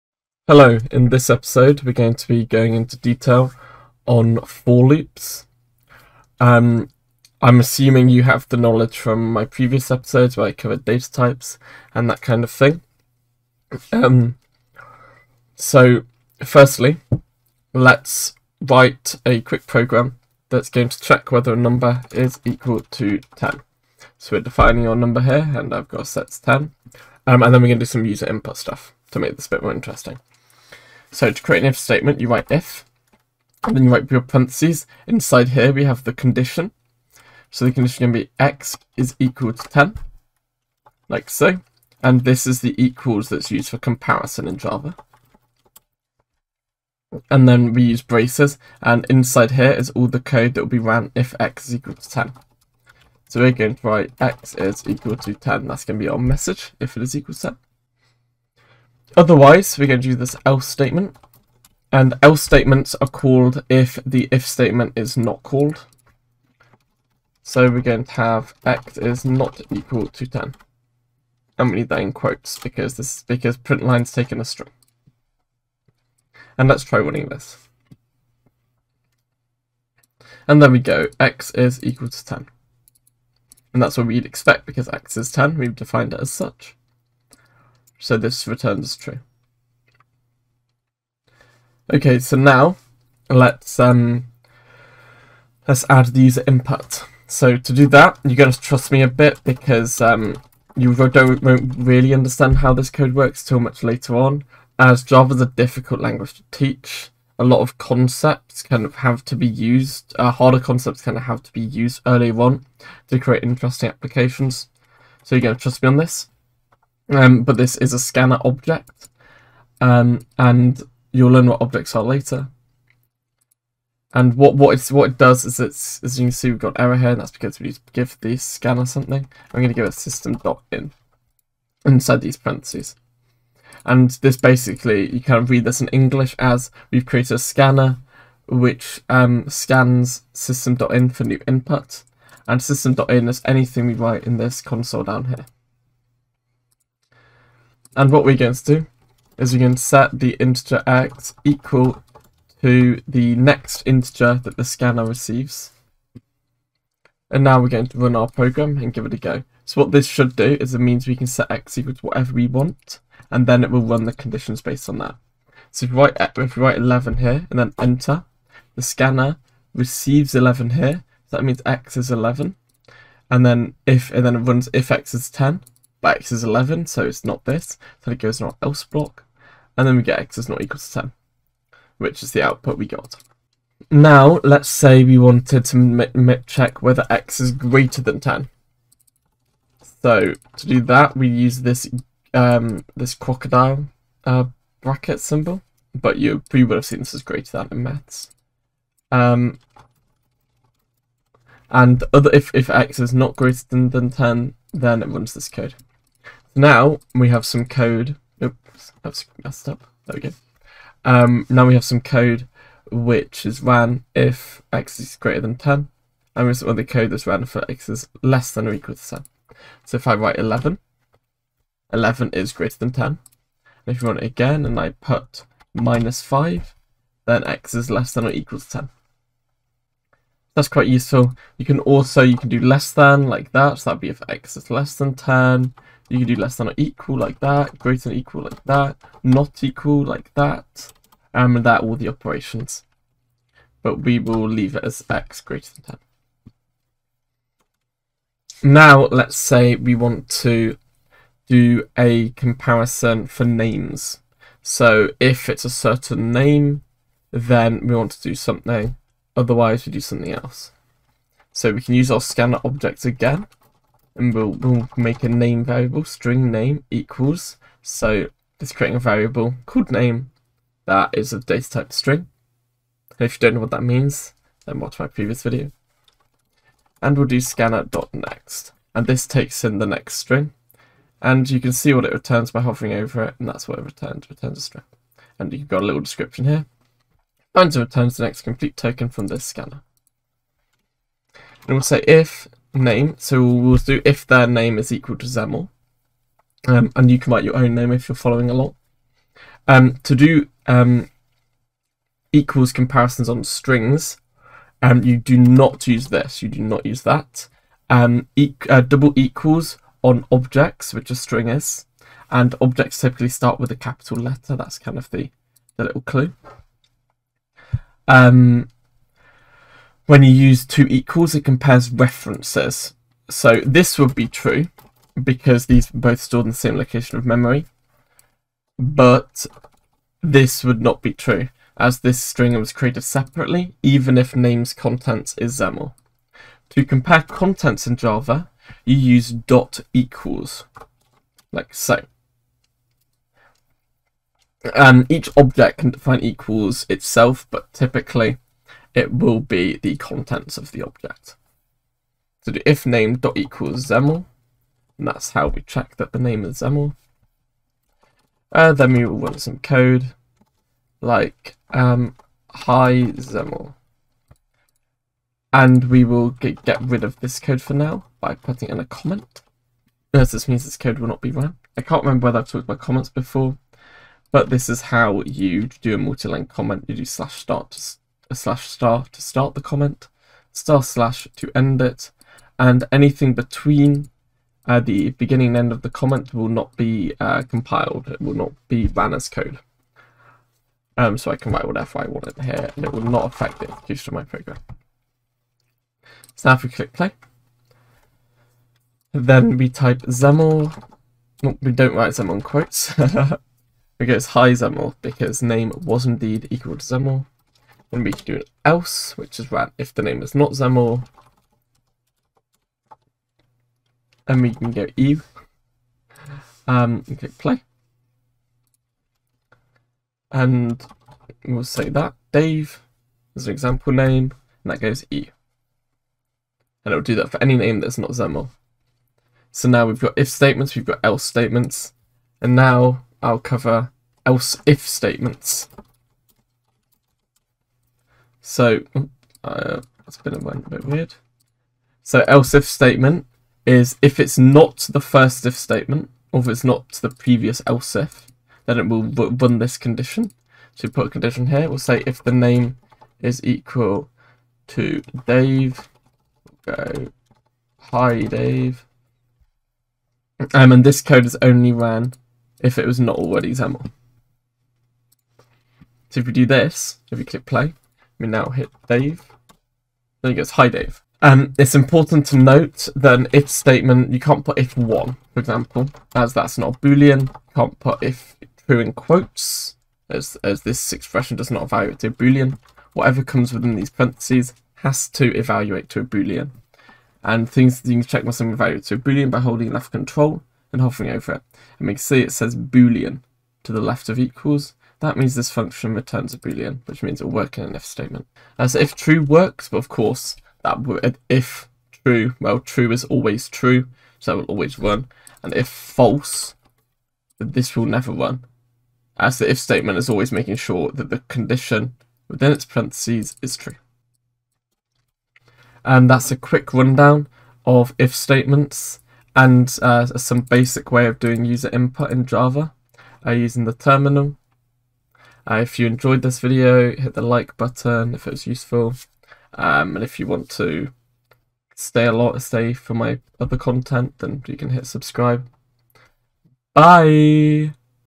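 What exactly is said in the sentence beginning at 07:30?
So put a condition here, we'll say if the name is equal to Dave, we'll go, hi Dave.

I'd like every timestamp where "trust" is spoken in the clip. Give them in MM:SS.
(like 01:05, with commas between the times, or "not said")
01:38, 01:55.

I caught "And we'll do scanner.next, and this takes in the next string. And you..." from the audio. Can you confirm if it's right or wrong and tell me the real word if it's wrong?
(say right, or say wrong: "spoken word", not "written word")
right.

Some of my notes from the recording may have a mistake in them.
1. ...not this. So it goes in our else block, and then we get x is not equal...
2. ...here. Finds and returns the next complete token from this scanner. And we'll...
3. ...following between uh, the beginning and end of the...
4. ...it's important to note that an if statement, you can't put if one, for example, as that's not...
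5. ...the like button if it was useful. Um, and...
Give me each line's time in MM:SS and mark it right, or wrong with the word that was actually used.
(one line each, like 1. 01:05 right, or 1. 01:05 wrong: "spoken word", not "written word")
1. 02:57 right
2. 04:46 right
3. 06:22 wrong: "anything", not "following"
4. 07:51 right
5. 08:47 right.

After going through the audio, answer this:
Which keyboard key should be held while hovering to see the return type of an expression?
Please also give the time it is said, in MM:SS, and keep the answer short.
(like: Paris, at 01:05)
left control, at 08:09.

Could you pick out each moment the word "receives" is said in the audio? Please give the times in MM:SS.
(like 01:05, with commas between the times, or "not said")
02:35, 02:49.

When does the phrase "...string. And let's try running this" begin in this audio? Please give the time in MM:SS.
01:14.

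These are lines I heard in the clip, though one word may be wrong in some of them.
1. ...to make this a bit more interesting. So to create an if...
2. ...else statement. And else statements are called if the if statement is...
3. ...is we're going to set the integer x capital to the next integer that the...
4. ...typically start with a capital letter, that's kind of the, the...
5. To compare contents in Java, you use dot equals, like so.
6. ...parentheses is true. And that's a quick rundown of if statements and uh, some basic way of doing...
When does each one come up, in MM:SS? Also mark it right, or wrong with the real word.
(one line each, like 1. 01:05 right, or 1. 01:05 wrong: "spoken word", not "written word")
1. 00:29 right
2. 01:00 right
3. 02:29 wrong: "equal", not "capital"
4. 05:12 right
5. 05:36 right
6. 08:32 right.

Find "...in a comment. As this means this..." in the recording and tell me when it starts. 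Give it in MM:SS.
06:08.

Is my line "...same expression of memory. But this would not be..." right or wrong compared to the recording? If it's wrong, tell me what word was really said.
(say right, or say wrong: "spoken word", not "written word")
wrong: "location", not "expression".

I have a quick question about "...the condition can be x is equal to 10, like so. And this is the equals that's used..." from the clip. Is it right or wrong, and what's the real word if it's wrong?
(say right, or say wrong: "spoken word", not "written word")
right.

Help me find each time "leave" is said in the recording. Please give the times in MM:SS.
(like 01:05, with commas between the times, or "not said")
04:04.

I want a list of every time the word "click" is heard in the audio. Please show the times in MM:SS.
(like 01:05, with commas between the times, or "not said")
06:36, 06:57, 07:47.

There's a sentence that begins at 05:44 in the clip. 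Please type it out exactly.
And each object can define equals itself, but typically it will be the contents of the object.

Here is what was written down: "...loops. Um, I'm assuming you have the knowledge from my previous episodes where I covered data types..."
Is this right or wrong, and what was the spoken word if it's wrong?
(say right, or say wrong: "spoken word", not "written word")
right.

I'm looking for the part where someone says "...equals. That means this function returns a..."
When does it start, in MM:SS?
08:14.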